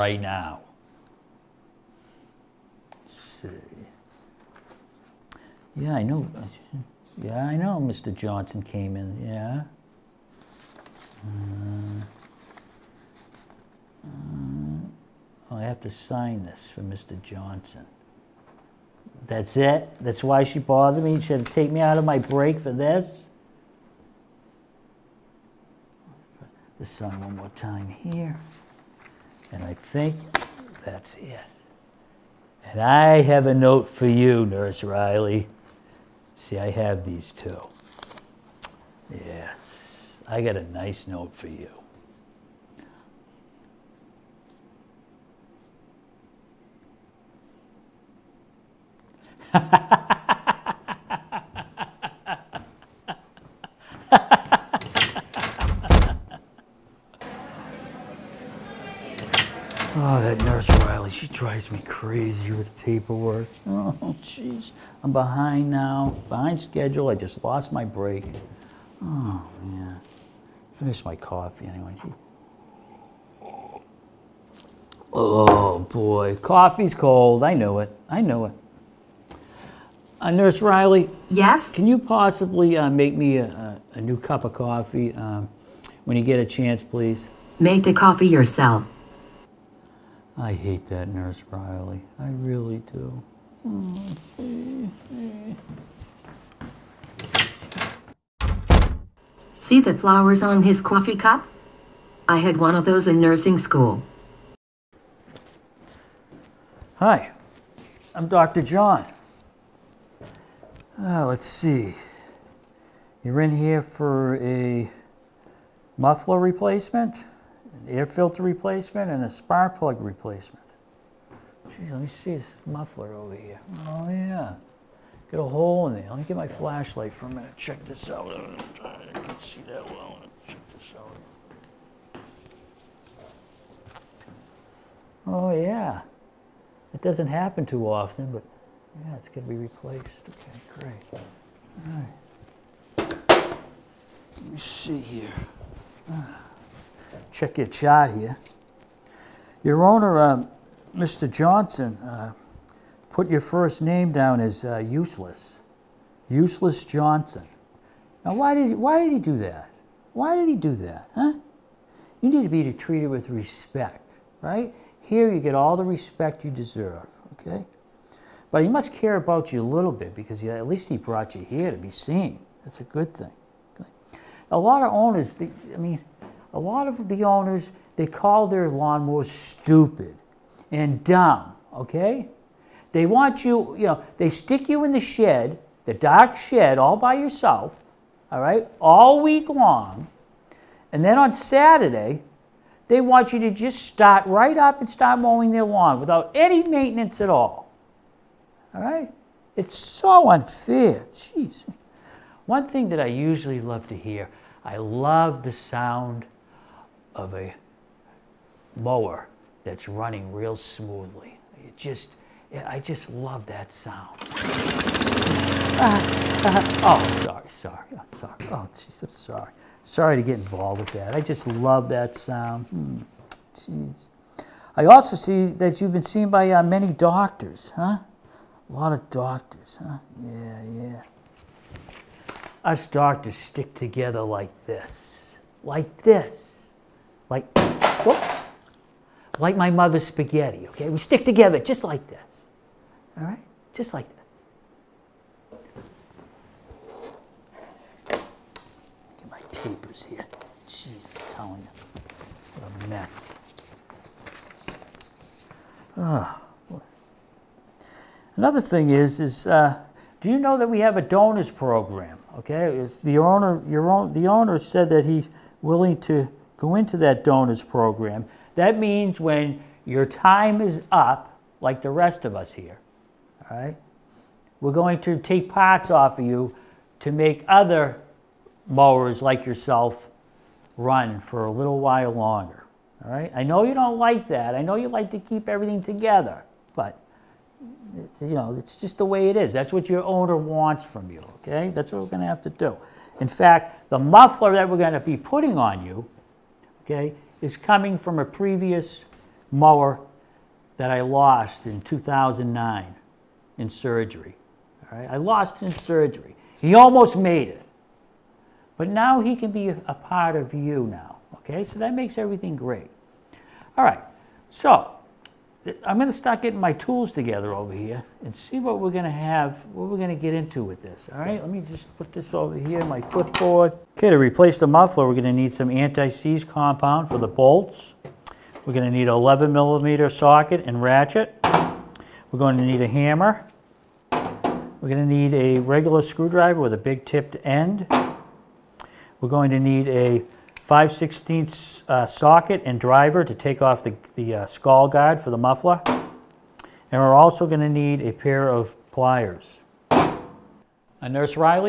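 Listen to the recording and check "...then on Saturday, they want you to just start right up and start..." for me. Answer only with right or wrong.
right.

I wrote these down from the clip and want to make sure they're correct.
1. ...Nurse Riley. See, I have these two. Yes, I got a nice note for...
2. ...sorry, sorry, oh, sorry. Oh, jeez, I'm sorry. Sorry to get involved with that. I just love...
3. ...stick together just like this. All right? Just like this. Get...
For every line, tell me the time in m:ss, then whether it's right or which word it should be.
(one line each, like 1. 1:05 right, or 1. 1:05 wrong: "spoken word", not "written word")
1. 0:34 right
2. 3:37 right
3. 4:00 right.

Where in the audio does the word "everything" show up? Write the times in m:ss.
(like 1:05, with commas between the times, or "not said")
4:45, 5:12.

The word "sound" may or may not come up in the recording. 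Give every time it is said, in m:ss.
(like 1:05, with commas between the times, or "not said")
3:25, 3:33, 3:42.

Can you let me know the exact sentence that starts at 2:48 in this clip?
But he must care about you a little bit because at least he brought you here to be seen.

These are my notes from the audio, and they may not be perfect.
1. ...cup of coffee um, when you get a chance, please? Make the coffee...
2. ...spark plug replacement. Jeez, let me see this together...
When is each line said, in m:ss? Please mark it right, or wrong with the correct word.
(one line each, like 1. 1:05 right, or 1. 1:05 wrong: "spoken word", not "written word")
1. 1:24 right
2. 1:59 wrong: "muffler", not "together".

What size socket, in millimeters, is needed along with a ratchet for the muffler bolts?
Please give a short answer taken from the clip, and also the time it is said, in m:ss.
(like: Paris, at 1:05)
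11 millimeter, at 5:29.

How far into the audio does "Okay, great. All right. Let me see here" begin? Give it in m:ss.
2:20.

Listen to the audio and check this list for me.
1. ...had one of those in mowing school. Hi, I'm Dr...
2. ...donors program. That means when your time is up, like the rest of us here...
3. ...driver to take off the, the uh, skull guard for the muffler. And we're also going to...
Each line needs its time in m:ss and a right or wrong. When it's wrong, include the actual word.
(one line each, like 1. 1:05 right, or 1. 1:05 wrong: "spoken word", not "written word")
1. 1:42 wrong: "nursing", not "mowing"
2. 4:27 right
3. 5:42 right.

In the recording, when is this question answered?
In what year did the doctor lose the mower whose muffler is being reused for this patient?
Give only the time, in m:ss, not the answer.
5:01.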